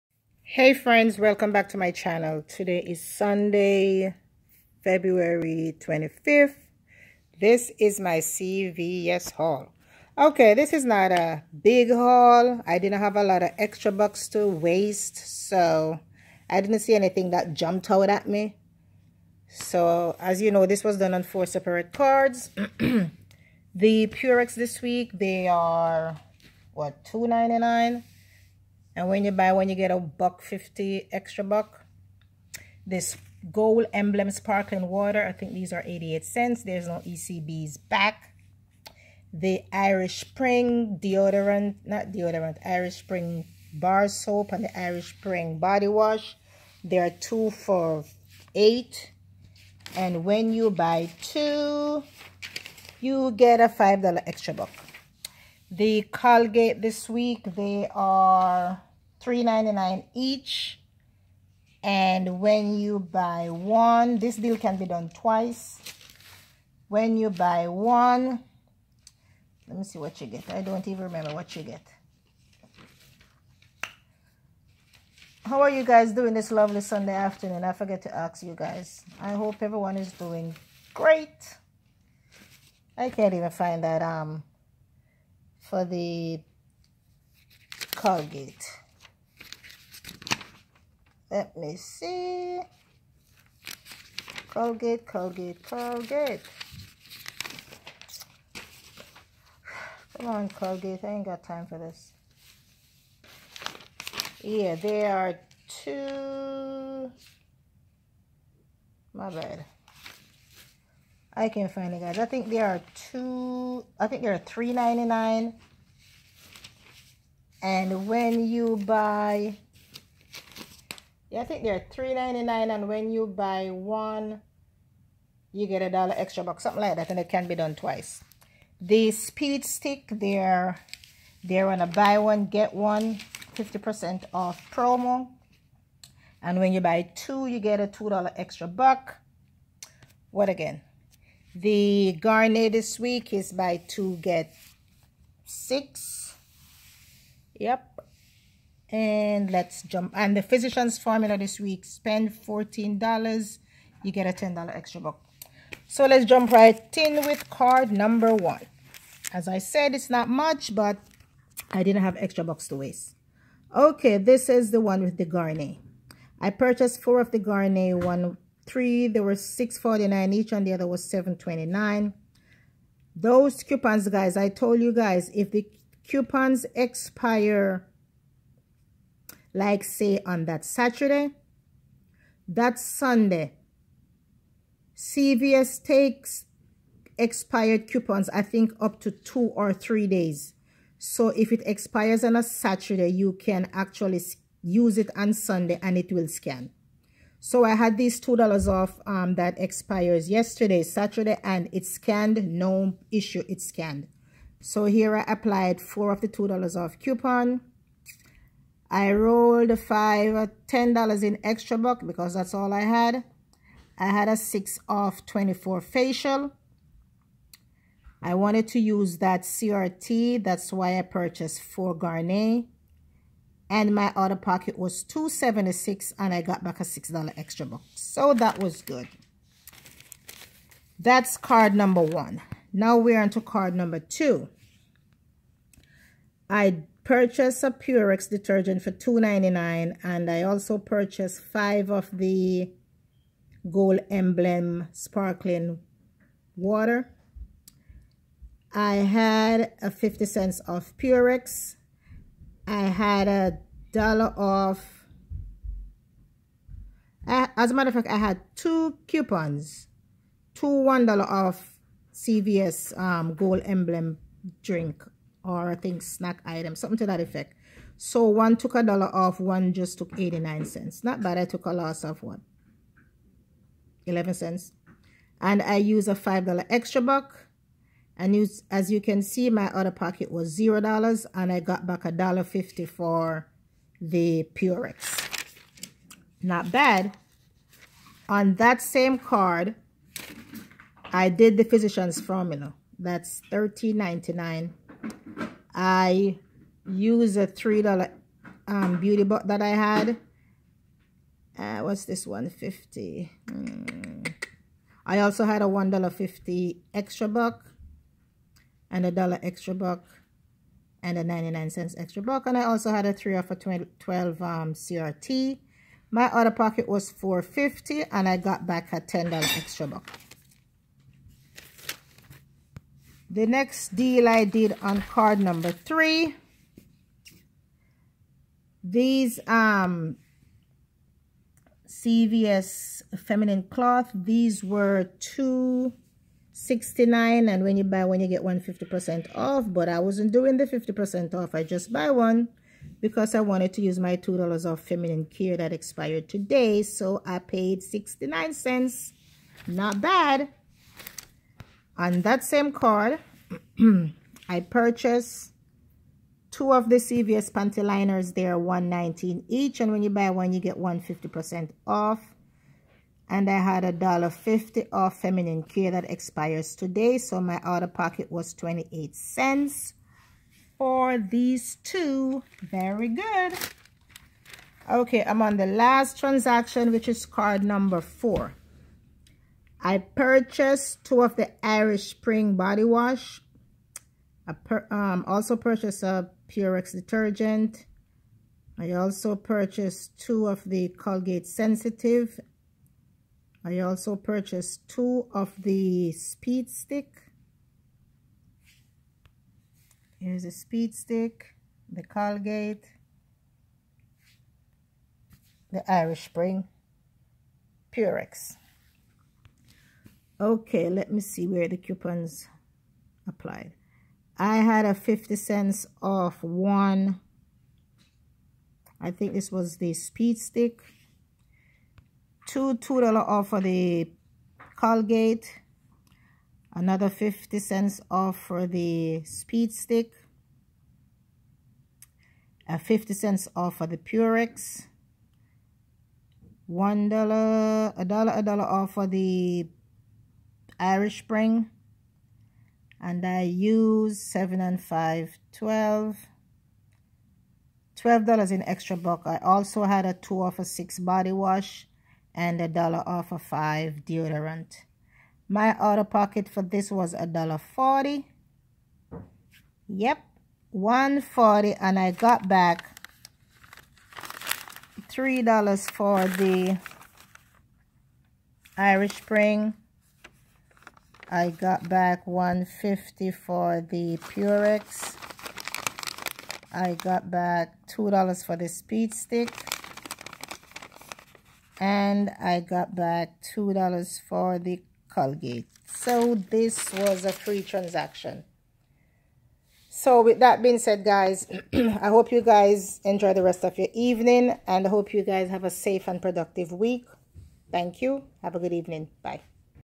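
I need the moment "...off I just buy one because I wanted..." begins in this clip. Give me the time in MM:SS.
05:41.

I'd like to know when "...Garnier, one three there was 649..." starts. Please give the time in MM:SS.
02:47.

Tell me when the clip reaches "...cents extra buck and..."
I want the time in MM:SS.
05:11.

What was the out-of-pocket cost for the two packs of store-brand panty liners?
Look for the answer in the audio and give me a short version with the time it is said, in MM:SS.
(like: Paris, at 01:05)
28 cents, at 06:08.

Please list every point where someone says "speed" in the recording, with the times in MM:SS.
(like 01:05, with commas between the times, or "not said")
02:09, 06:36, 06:40, 06:59, 07:09, 07:58.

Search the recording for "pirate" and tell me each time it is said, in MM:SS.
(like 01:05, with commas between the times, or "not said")
not said.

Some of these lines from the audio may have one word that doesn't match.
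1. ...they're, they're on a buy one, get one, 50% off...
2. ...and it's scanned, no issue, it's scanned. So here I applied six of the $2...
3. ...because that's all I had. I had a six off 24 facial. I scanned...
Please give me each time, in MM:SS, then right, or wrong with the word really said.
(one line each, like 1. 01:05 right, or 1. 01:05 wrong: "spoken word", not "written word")
1. 02:10 right
2. 03:21 wrong: "four", not "six"
3. 03:32 wrong: "wanted", not "scanned".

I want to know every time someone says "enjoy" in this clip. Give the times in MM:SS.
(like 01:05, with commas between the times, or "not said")
08:13.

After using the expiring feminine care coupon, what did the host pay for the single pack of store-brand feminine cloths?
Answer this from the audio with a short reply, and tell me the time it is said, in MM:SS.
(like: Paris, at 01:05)
69 cents, at 05:47.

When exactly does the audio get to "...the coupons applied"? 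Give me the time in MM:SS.
06:51.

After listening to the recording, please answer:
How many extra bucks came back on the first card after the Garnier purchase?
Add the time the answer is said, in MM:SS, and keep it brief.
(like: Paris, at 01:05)
$6, at 03:46.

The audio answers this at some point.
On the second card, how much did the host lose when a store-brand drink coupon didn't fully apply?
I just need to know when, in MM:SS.
04:34.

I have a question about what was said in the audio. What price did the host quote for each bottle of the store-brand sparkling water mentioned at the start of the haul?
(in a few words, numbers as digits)
88 cents.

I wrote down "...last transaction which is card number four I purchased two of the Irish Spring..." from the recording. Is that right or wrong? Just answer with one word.
right.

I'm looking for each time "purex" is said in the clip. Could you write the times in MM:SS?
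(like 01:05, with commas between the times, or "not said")
00:24, 03:57, 04:10, 04:44, 06:26, 06:47, 07:13, 07:54.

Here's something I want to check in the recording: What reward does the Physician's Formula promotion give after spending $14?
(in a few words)
$10 extra buck.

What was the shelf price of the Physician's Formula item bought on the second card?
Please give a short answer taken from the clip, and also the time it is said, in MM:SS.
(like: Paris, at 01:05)
$13.99, at 04:53.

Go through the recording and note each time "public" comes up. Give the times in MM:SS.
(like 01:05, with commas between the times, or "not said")
not said.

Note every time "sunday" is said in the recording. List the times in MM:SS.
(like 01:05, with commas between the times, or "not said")
00:03, 01:16, 03:02, 03:15.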